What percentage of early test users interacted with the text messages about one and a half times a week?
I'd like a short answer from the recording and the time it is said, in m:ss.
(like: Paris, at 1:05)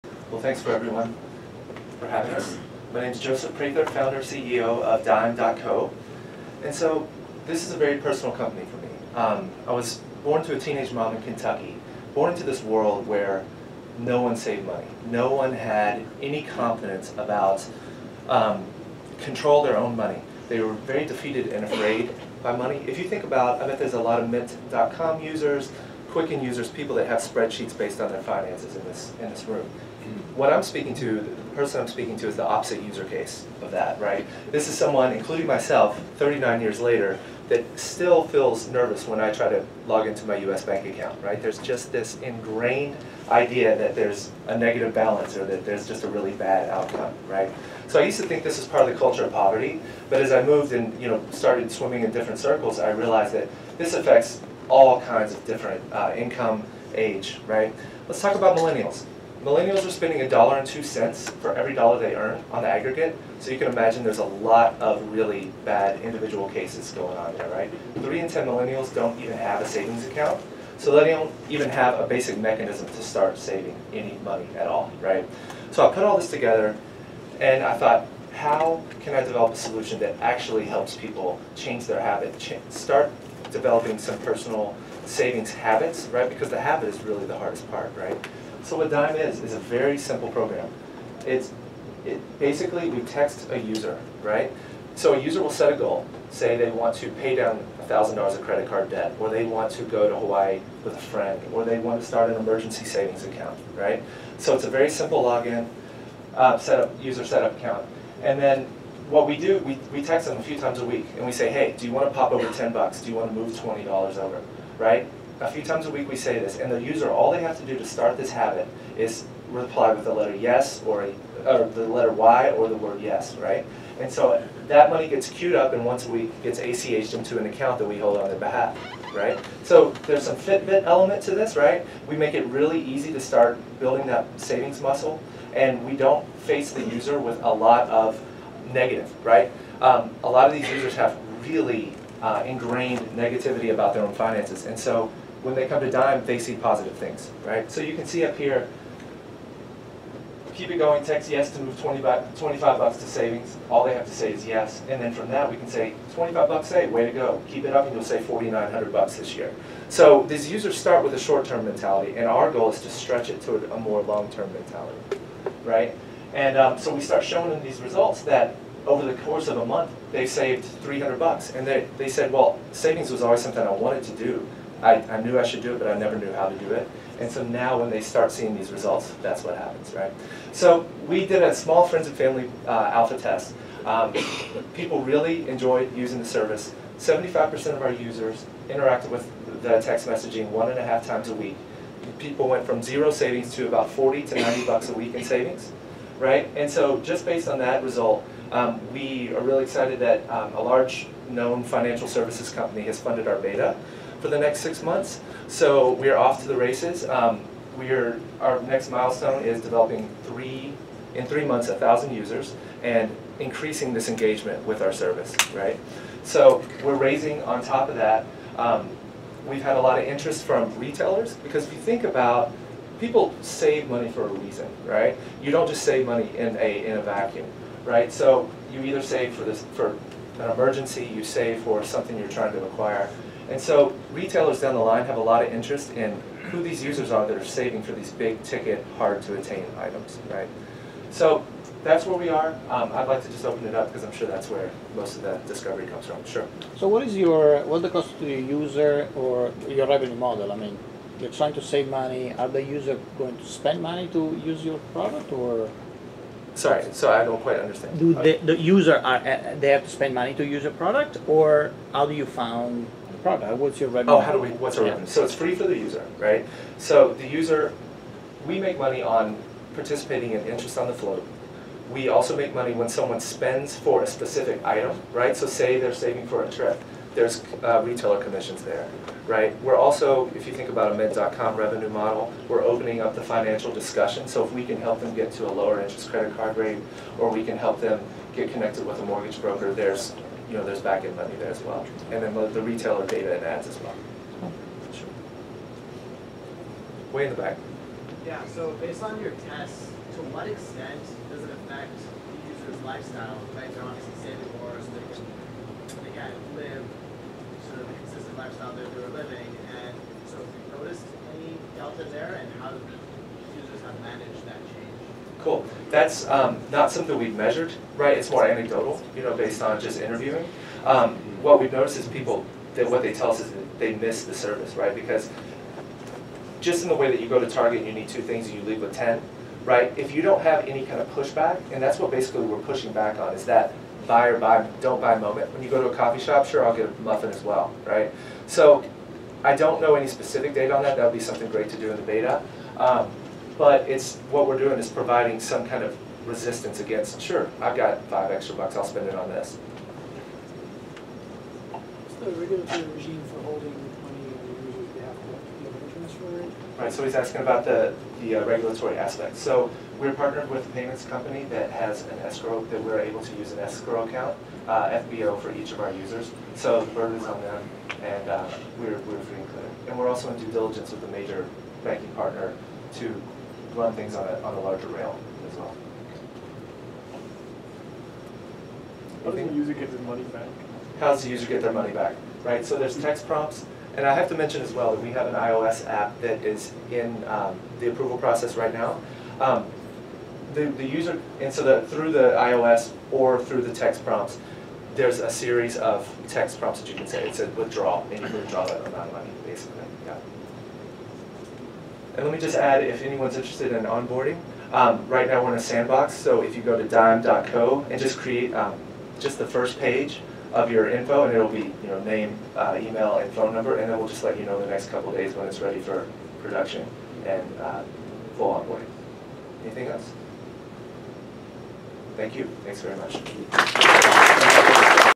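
75%, at 3:06.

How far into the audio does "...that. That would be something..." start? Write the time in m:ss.
5:40.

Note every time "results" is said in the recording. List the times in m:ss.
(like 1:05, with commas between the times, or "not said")
2:47, 2:58, 3:17.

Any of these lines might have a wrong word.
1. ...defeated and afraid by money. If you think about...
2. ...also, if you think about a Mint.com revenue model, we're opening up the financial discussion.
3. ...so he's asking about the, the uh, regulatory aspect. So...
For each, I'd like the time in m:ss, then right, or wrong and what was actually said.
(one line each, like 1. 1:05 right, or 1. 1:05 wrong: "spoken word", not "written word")
1. 0:21 right
2. 4:39 right
3. 5:56 right.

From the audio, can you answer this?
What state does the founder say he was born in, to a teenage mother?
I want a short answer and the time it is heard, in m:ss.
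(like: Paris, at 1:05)
Kentucky, at 0:11.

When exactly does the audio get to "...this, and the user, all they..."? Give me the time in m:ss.
1:56.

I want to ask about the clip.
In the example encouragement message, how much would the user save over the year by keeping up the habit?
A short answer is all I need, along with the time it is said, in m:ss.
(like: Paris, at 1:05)
$4,900, at 2:38.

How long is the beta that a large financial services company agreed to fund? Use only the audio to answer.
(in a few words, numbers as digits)
6 months.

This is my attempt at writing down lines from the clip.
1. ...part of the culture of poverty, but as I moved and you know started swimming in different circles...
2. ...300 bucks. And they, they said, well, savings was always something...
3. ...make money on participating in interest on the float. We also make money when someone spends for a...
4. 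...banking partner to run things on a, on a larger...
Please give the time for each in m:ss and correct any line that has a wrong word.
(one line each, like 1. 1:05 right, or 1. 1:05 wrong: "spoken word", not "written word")
1. 0:48 right
2. 2:50 right
3. 4:28 right
4. 6:11 right.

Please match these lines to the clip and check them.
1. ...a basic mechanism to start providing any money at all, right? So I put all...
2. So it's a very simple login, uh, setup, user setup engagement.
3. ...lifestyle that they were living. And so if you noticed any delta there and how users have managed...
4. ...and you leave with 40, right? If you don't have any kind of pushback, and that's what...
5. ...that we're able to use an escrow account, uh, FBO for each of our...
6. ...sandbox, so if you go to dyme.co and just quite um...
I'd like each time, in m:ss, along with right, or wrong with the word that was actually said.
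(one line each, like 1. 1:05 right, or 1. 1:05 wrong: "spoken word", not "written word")
1. 1:11 wrong: "saving", not "providing"
2. 1:44 wrong: "account", not "engagement"
3. 5:08 right
4. 5:28 wrong: "10", not "40"
5. 6:02 right
6. 6:45 wrong: "create", not "quite".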